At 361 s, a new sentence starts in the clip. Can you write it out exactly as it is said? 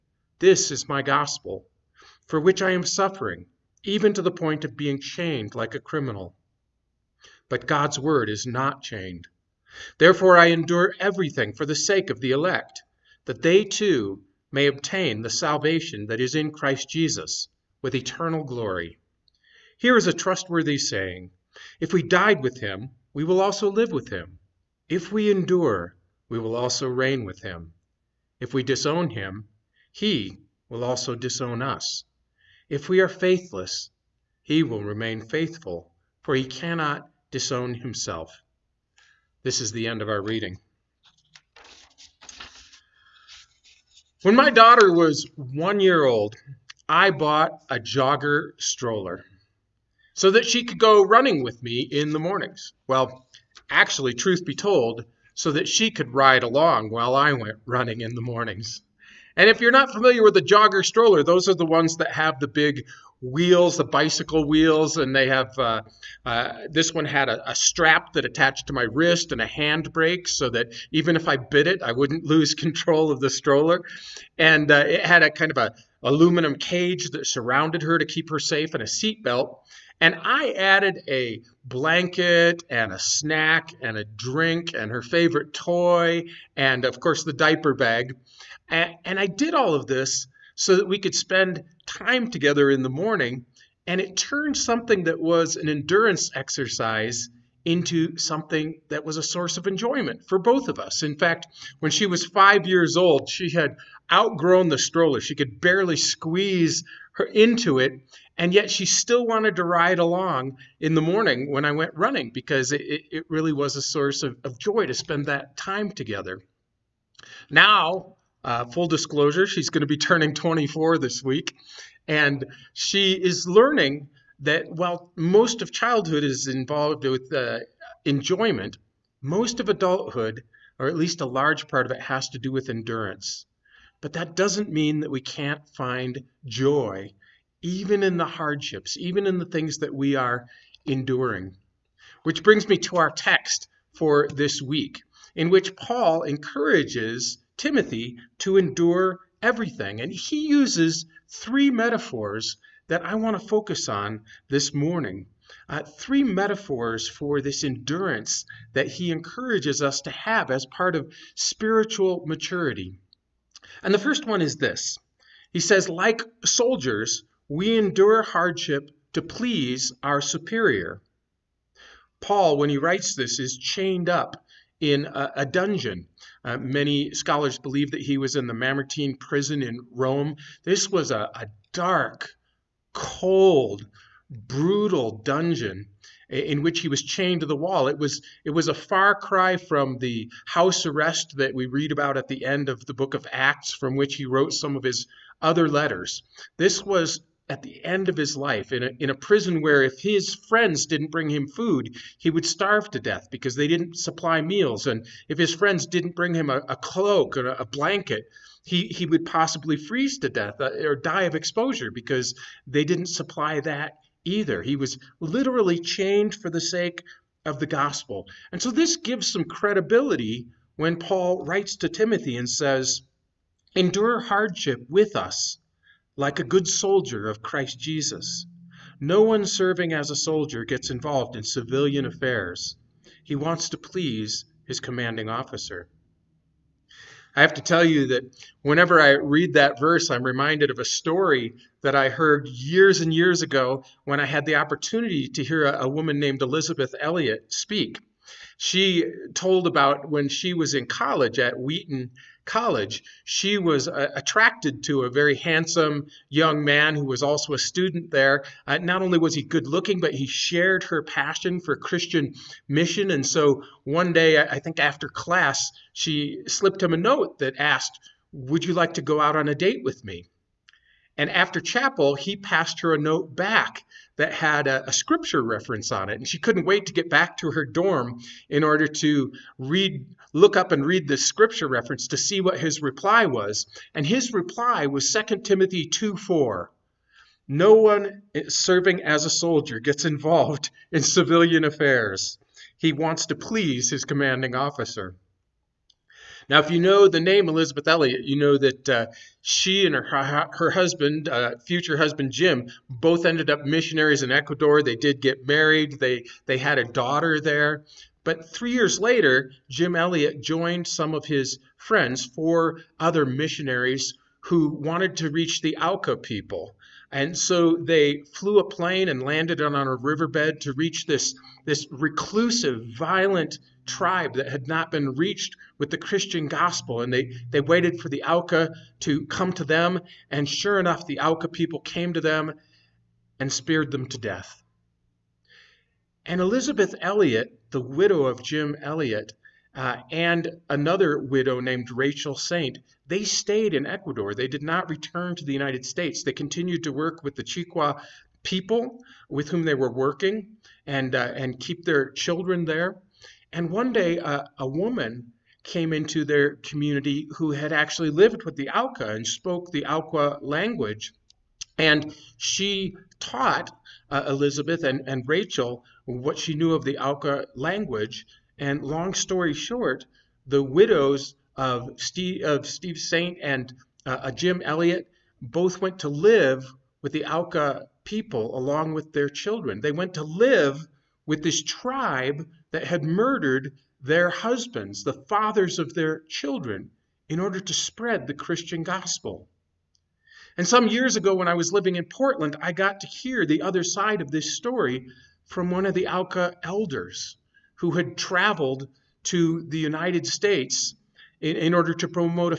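And she taught uh, Elizabeth and, and Rachel what she knew of the Auca language.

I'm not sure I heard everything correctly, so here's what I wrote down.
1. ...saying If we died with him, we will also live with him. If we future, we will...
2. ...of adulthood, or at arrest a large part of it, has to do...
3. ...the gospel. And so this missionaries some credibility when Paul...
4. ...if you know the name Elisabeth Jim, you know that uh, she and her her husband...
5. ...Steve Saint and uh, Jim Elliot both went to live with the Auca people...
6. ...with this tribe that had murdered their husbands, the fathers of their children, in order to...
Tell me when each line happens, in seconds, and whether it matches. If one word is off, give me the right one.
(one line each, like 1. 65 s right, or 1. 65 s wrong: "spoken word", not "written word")
1. 20 s wrong: "endure", not "future"
2. 129 s wrong: "least", not "arrest"
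3. 217 s wrong: "gives", not "missionaries"
4. 296 s wrong: "Elliot", not "Jim"
5. 372 s right
6. 381 s right.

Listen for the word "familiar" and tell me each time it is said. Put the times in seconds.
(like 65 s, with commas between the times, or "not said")
59 s.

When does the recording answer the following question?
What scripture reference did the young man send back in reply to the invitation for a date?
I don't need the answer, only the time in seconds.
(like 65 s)
285 s.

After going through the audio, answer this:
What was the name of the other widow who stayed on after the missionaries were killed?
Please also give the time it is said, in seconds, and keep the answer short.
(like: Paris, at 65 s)
Rachel Saint, at 341 s.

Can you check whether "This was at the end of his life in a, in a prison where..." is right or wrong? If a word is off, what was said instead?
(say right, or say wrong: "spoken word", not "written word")
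right.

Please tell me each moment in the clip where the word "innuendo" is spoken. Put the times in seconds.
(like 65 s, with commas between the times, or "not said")
not said.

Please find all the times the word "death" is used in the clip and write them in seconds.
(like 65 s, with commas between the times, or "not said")
202 s, 210 s, 334 s.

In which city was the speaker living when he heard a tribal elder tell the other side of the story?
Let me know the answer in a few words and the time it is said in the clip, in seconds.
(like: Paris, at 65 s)
Portland, at 392 s.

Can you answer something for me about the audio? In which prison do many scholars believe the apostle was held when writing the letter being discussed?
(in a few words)
Mamertine prison.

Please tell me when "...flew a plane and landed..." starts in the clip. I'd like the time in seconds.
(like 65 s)
318 s.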